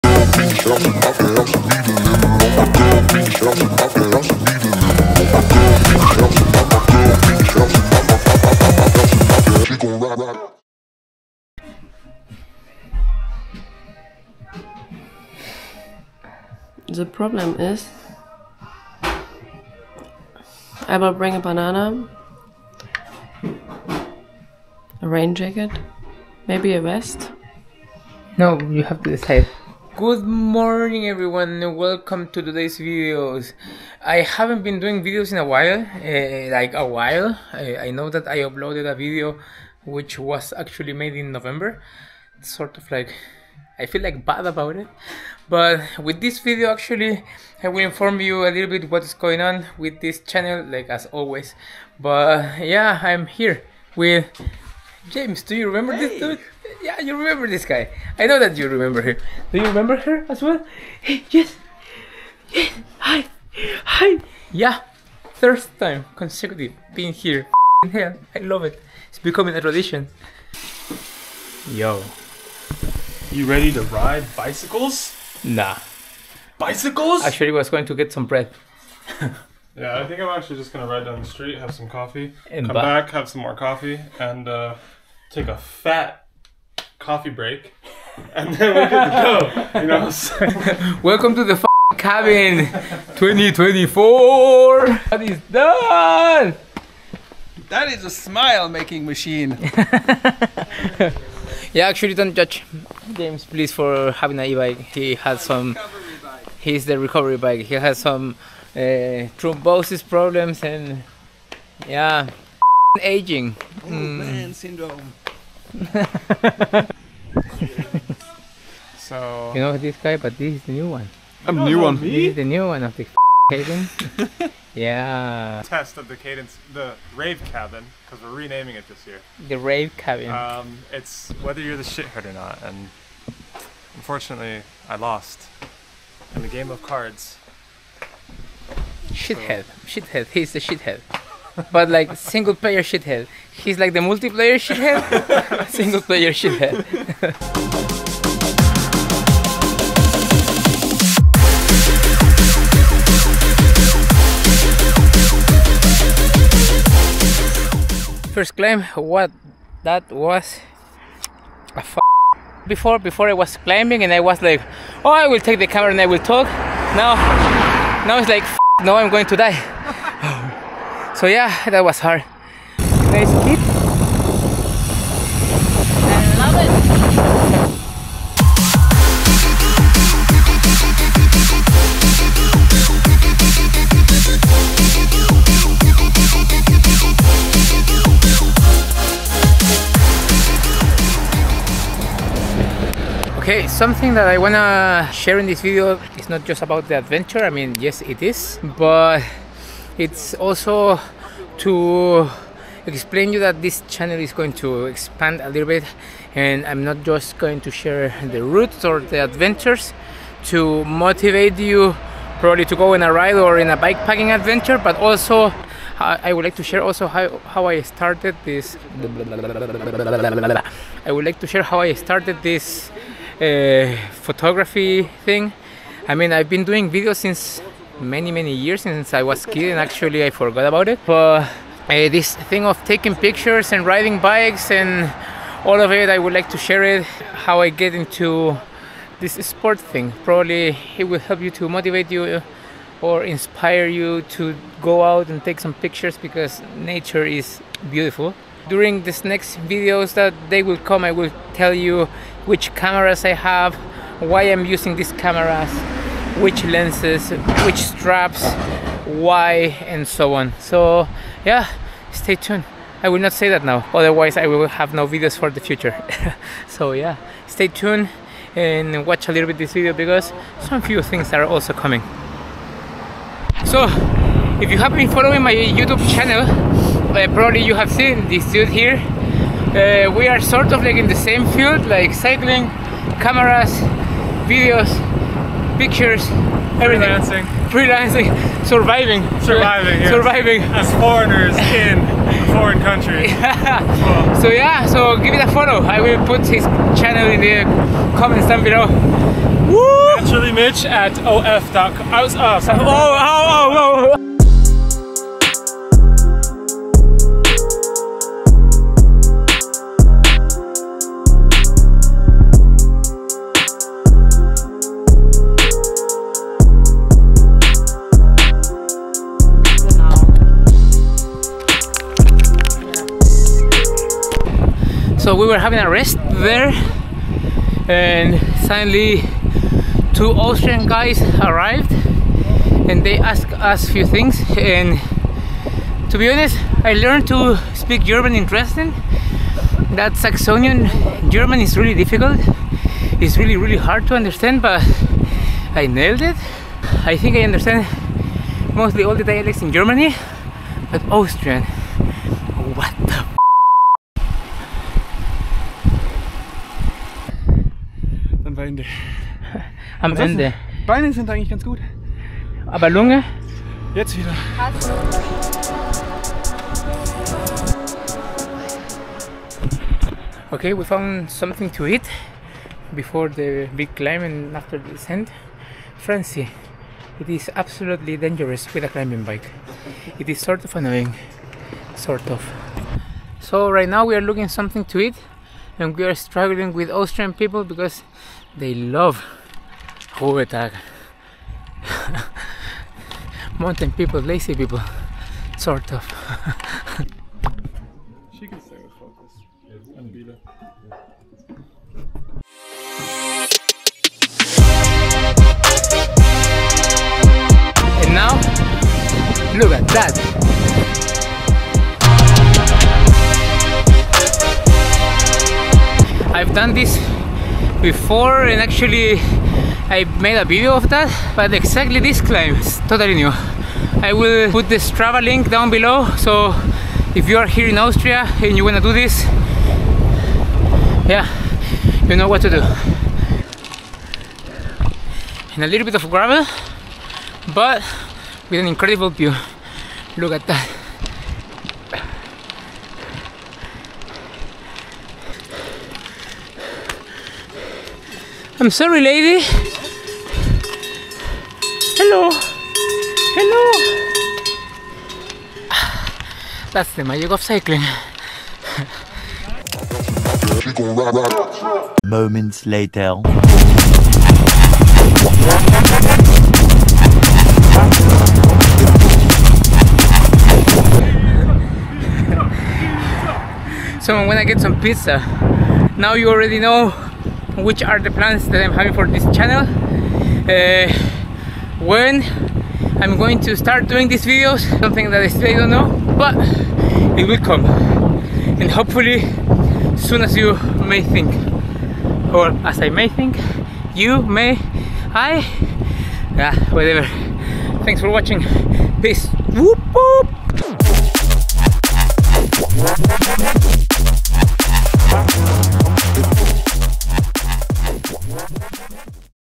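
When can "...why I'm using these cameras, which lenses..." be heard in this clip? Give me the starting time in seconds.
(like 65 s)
254 s.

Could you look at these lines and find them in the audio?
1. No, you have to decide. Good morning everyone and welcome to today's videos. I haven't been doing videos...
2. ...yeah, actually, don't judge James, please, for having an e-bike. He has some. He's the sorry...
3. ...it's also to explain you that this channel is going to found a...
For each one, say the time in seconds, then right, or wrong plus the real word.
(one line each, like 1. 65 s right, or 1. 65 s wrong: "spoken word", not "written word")
1. 28 s right
2. 101 s wrong: "recovery", not "sorry"
3. 199 s wrong: "expand", not "found".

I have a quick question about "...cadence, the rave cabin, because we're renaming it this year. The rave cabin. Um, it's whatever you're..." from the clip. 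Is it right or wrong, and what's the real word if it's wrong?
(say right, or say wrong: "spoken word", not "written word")
wrong: "whether", not "whatever".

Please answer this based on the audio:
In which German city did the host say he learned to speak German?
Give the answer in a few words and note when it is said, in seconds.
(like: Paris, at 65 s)
Dresden, at 338 s.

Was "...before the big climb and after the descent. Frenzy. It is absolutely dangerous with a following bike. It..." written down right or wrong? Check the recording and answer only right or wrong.
wrong.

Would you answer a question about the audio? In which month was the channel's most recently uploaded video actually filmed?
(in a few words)
November.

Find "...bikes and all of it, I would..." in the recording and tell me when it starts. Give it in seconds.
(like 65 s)
234 s.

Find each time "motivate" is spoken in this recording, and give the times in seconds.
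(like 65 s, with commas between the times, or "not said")
210 s, 241 s.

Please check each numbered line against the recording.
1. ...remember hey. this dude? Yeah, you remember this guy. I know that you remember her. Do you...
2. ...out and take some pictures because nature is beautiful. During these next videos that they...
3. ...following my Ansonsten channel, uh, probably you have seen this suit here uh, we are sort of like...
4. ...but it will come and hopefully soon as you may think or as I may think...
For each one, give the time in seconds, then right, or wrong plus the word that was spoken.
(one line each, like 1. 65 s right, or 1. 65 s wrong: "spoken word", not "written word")
1. 55 s right
2. 245 s right
3. 275 s wrong: "YouTube", not "Ansonsten"
4. 486 s right.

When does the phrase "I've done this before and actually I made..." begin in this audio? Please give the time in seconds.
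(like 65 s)
416 s.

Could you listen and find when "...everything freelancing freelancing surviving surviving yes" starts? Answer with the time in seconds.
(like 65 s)
286 s.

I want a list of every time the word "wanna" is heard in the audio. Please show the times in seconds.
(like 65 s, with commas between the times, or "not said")
194 s.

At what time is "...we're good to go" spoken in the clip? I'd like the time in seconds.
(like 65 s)
88 s.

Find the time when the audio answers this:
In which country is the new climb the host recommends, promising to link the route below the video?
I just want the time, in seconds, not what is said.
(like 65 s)
427 s.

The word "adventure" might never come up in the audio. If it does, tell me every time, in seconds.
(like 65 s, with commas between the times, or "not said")
196 s, 209 s, 214 s.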